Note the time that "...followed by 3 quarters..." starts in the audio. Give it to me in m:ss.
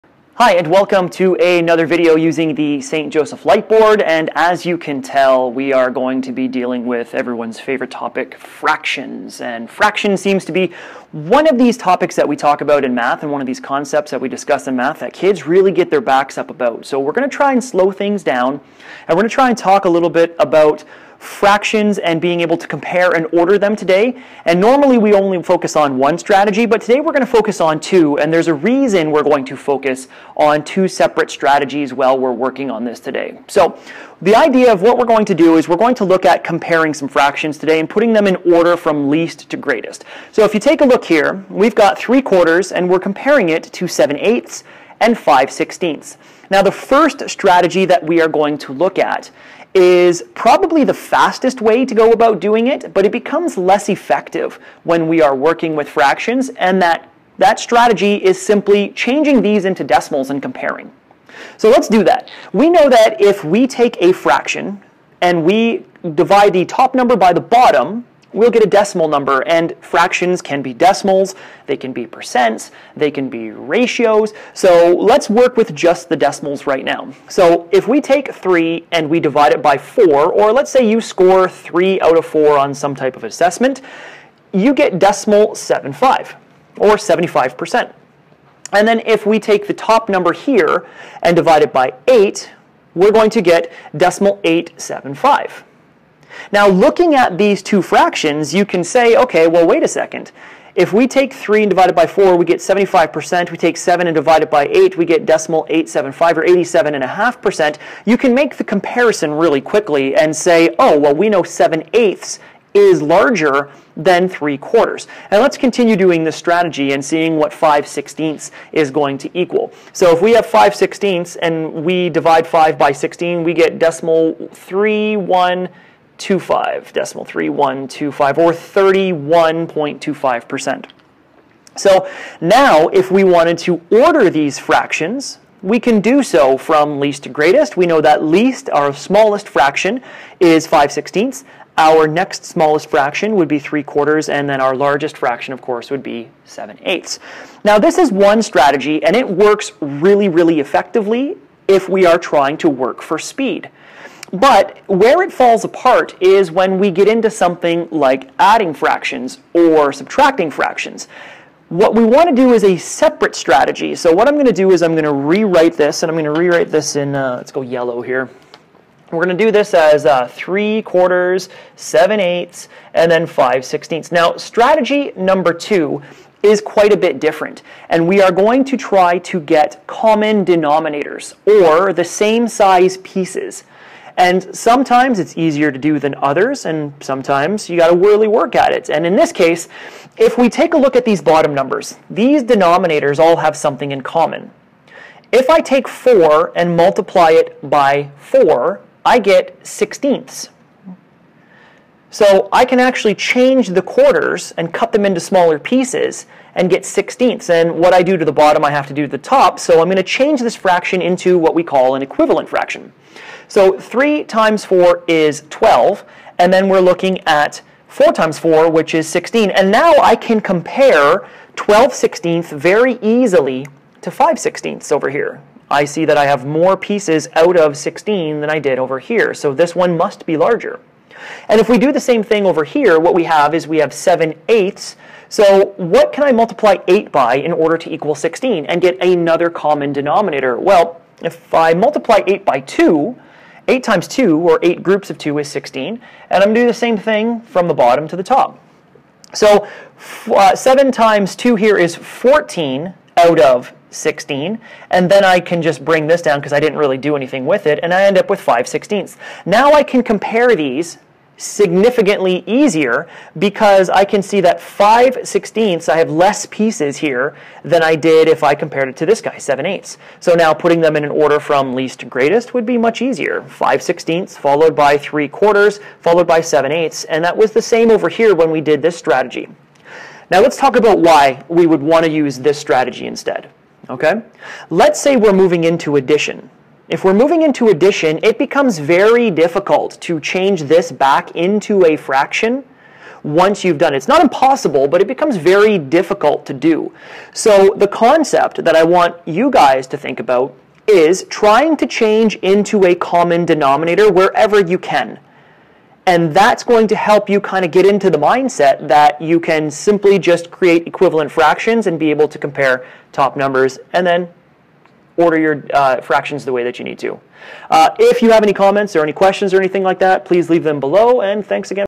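4:34.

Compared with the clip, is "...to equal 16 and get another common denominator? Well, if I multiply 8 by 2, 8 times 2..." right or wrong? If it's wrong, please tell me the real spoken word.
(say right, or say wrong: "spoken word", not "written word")
right.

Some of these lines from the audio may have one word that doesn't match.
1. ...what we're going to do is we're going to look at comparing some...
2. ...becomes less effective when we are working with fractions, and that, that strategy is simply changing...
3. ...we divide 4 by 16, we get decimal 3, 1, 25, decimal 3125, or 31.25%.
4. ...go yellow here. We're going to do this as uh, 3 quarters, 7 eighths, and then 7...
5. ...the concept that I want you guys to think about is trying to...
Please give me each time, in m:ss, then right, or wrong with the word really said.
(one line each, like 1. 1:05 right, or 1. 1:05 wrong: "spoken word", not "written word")
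1. 0:34 right
2. 0:53 right
3. 2:01 wrong: "5", not "4"
4. 2:47 wrong: "5", not "7"
5. 4:57 right.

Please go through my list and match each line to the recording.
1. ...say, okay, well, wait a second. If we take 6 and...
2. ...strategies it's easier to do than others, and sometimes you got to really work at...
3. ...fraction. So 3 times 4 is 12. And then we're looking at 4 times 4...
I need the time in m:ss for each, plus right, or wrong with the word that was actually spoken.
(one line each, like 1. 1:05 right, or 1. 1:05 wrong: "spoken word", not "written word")
1. 1:38 wrong: "3", not "6"
2. 3:04 wrong: "sometimes", not "strategies"
3. 3:32 right.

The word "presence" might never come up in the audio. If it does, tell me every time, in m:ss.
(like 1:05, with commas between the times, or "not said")
not said.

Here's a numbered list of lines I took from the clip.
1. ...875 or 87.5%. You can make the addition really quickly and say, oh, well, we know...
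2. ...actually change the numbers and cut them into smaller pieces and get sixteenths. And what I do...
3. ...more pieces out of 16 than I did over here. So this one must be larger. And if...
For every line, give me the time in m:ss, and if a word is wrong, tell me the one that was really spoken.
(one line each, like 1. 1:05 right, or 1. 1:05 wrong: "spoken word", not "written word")
1. 1:45 wrong: "comparison", not "addition"
2. 3:22 wrong: "quarters", not "numbers"
3. 3:46 right.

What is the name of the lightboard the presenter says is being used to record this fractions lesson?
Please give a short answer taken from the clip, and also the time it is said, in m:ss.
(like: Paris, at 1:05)
St. Joseph Lightboard, at 0:02.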